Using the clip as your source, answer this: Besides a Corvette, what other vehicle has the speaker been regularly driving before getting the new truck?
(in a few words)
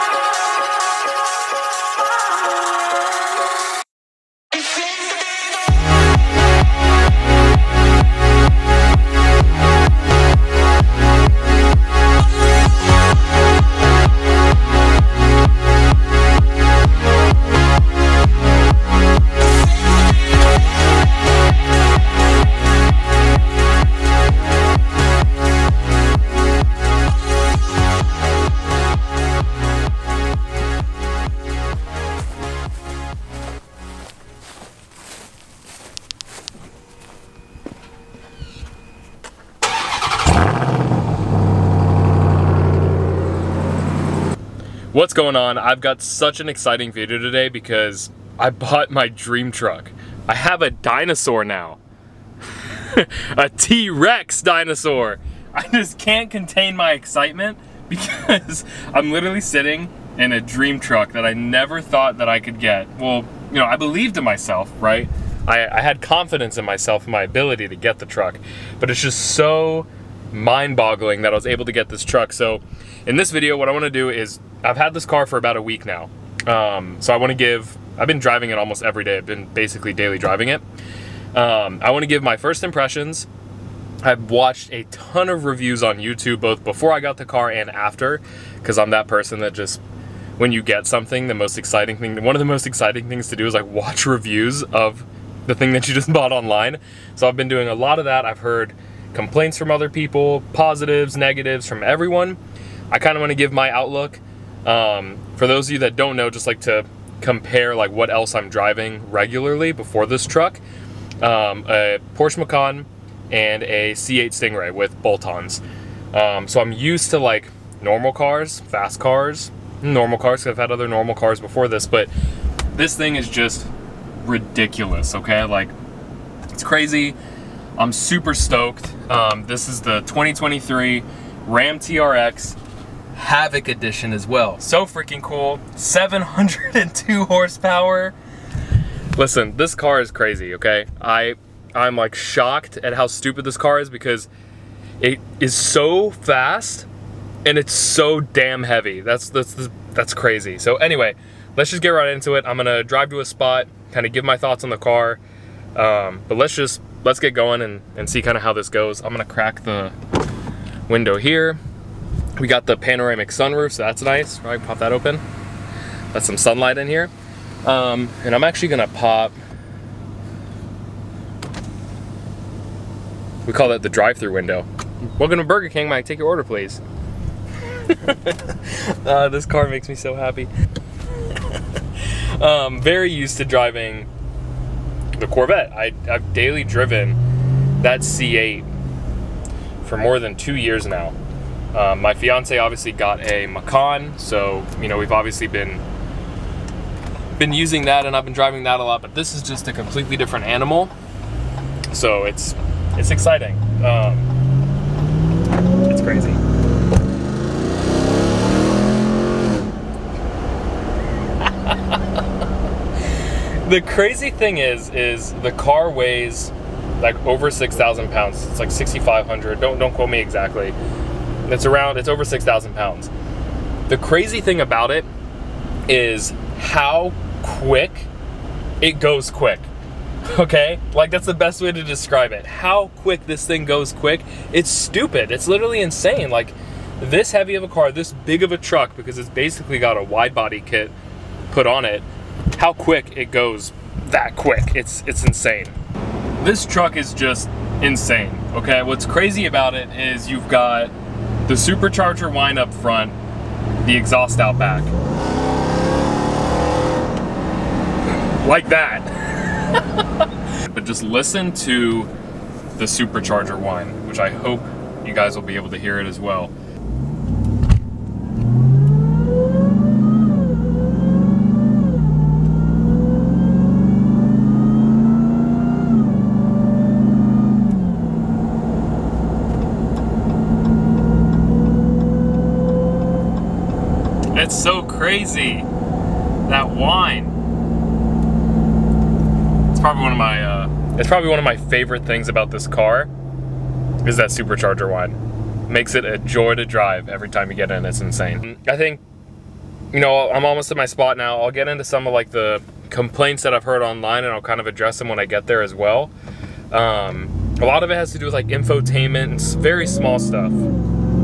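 Porsche Macan.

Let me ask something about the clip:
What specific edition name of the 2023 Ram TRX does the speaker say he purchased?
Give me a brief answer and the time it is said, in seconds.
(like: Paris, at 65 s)
Havoc Edition, at 133 s.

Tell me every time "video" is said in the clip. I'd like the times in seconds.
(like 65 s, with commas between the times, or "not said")
46 s, 73 s.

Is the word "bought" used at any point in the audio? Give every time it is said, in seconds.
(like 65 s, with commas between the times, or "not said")
48 s, 96 s.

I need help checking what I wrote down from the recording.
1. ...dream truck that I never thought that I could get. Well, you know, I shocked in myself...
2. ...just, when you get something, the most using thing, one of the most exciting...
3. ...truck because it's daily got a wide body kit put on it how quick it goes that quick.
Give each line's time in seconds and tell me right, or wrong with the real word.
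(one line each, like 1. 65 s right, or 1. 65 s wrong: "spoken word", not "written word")
1. 60 s wrong: "believed", not "shocked"
2. 89 s wrong: "exciting", not "using"
3. 238 s wrong: "basically", not "daily".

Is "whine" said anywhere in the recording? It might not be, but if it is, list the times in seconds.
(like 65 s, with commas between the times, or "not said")
263 s, 286 s, 294 s.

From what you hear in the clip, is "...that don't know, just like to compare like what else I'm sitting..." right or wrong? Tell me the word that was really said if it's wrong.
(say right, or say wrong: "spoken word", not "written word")
wrong: "driving", not "sitting".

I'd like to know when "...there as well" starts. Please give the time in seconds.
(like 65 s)
305 s.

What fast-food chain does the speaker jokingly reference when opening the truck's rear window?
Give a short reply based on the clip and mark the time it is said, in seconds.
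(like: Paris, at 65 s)
Burger King, at 175 s.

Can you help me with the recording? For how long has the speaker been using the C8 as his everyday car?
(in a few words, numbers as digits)
more than two years.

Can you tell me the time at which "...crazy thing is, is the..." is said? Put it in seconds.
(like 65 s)
213 s.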